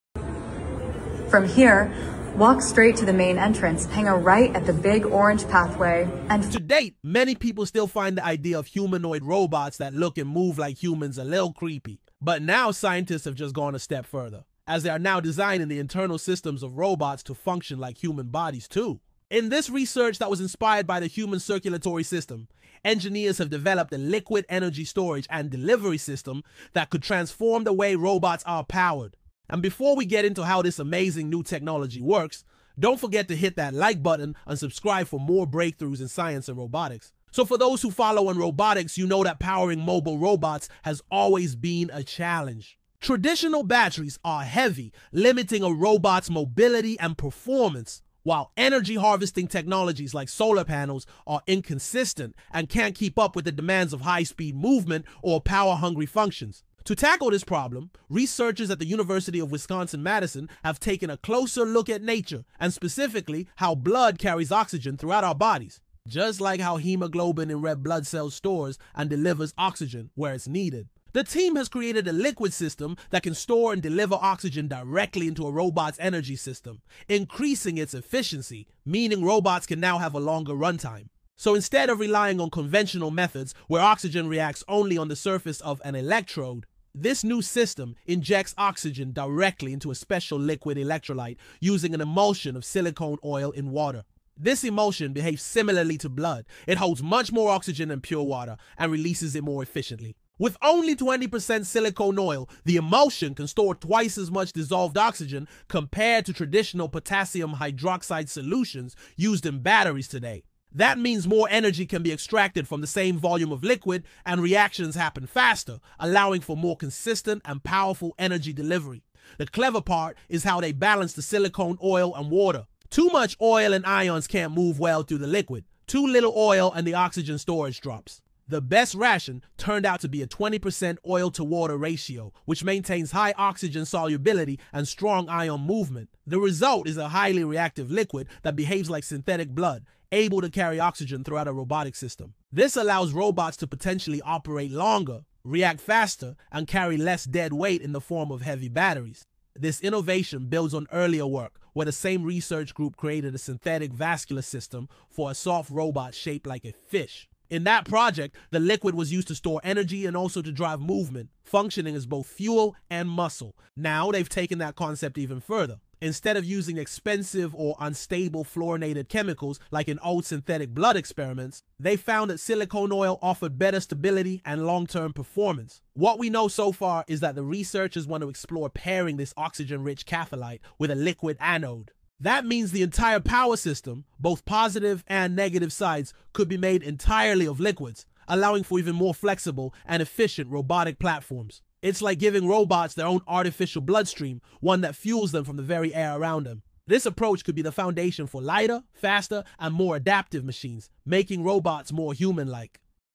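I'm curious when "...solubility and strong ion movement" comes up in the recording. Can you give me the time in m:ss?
2:13.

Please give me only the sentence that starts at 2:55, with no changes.
What we know so far is that the researchers want to explore pairing this oxygen-rich catholyte with a liquid anode.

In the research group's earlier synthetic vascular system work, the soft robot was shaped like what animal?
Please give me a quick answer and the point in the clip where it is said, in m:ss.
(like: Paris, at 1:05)
A fish, at 2:36.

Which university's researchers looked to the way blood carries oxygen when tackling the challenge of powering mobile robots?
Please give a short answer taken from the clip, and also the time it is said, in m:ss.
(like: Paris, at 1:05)
University of Wisconsin-Madison, at 0:58.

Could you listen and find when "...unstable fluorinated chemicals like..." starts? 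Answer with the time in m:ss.
2:47.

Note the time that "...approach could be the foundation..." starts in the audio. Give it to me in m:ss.
3:17.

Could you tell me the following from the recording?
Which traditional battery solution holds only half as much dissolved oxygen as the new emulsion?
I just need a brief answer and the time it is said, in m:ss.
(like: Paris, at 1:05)
potassium hydroxide, at 1:46.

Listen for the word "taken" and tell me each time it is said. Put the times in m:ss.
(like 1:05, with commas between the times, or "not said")
1:00, 2:44.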